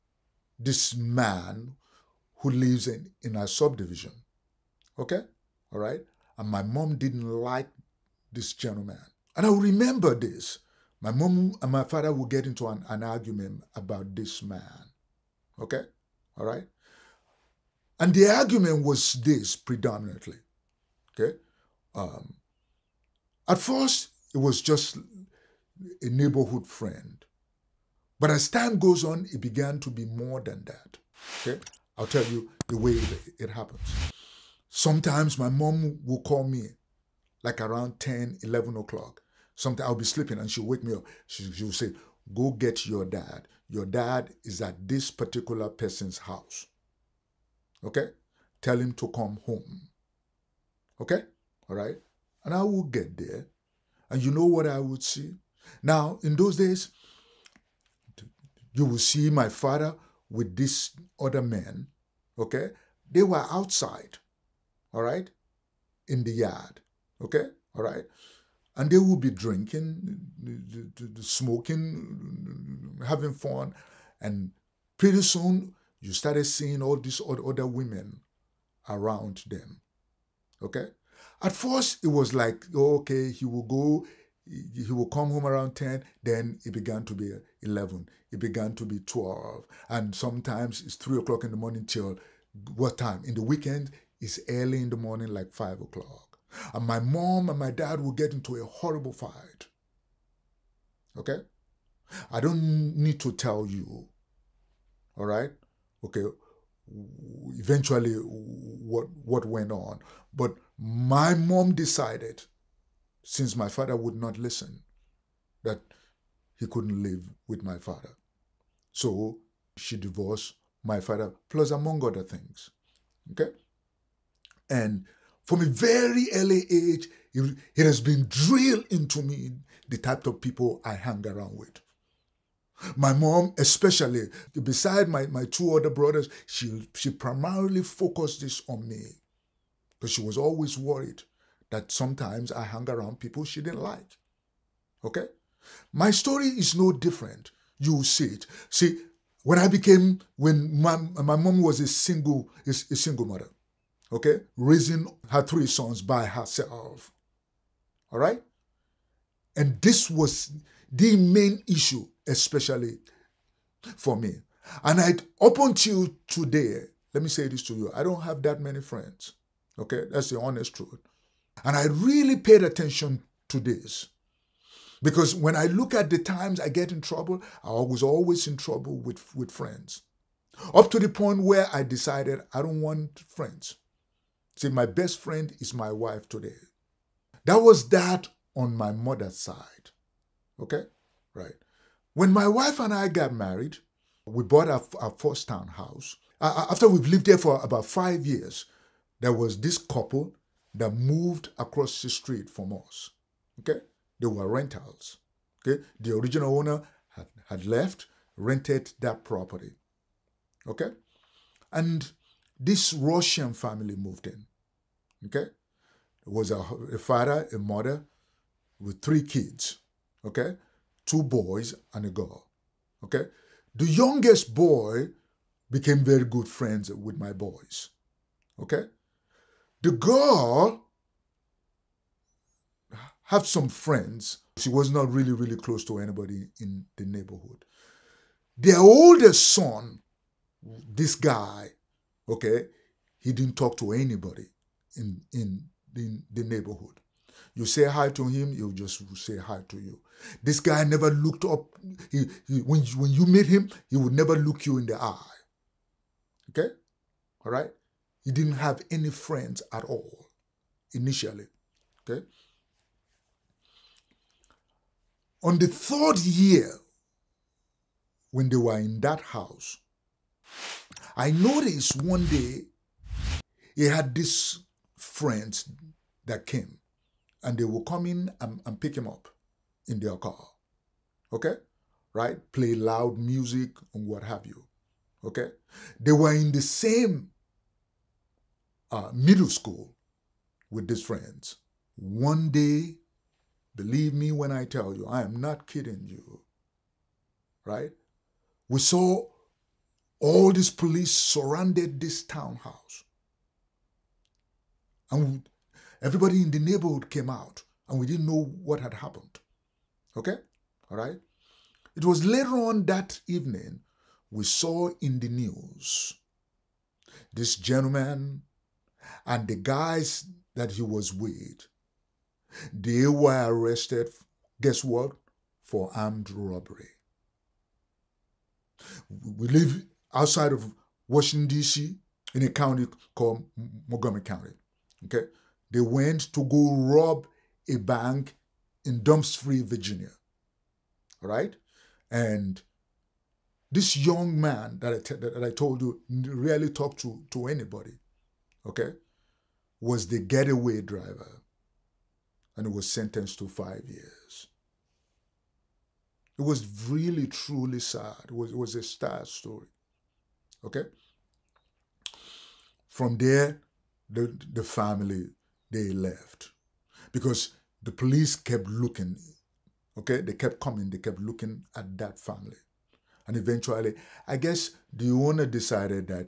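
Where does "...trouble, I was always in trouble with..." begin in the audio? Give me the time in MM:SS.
02:56.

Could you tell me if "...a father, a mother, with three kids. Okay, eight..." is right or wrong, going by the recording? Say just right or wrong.
wrong.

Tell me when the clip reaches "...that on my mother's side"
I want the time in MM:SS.
03:07.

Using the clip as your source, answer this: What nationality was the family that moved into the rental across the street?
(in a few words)
Russian.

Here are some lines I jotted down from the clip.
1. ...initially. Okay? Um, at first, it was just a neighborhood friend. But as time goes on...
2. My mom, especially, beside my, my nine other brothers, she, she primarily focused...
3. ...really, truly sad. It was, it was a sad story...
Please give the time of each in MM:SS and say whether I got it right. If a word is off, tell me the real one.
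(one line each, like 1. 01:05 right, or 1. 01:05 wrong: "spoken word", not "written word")
1. 00:19 wrong: "predominantly", not "initially"
2. 02:12 wrong: "two", not "nine"
3. 05:56 right.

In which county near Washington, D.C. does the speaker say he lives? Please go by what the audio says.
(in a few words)
Montgomery County.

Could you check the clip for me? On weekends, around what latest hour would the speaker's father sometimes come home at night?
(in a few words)
5 o'clock.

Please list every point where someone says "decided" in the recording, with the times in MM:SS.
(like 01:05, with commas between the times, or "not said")
01:51, 03:01, 06:15.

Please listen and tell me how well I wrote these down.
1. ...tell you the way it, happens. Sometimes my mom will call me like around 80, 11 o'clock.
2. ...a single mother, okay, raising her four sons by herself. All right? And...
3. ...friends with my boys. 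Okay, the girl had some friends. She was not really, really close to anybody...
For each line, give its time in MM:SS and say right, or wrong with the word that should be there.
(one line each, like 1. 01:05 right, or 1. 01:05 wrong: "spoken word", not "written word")
1. 00:32 wrong: "10", not "80"
2. 02:32 wrong: "three", not "four"
3. 03:46 right.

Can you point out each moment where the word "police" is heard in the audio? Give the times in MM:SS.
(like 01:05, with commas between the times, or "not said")
05:00, 06:07.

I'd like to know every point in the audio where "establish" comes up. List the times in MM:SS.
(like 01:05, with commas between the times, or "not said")
not said.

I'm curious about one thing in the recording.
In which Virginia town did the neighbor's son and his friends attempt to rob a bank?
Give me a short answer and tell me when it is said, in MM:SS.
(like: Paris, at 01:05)
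Dumfries, at 05:39.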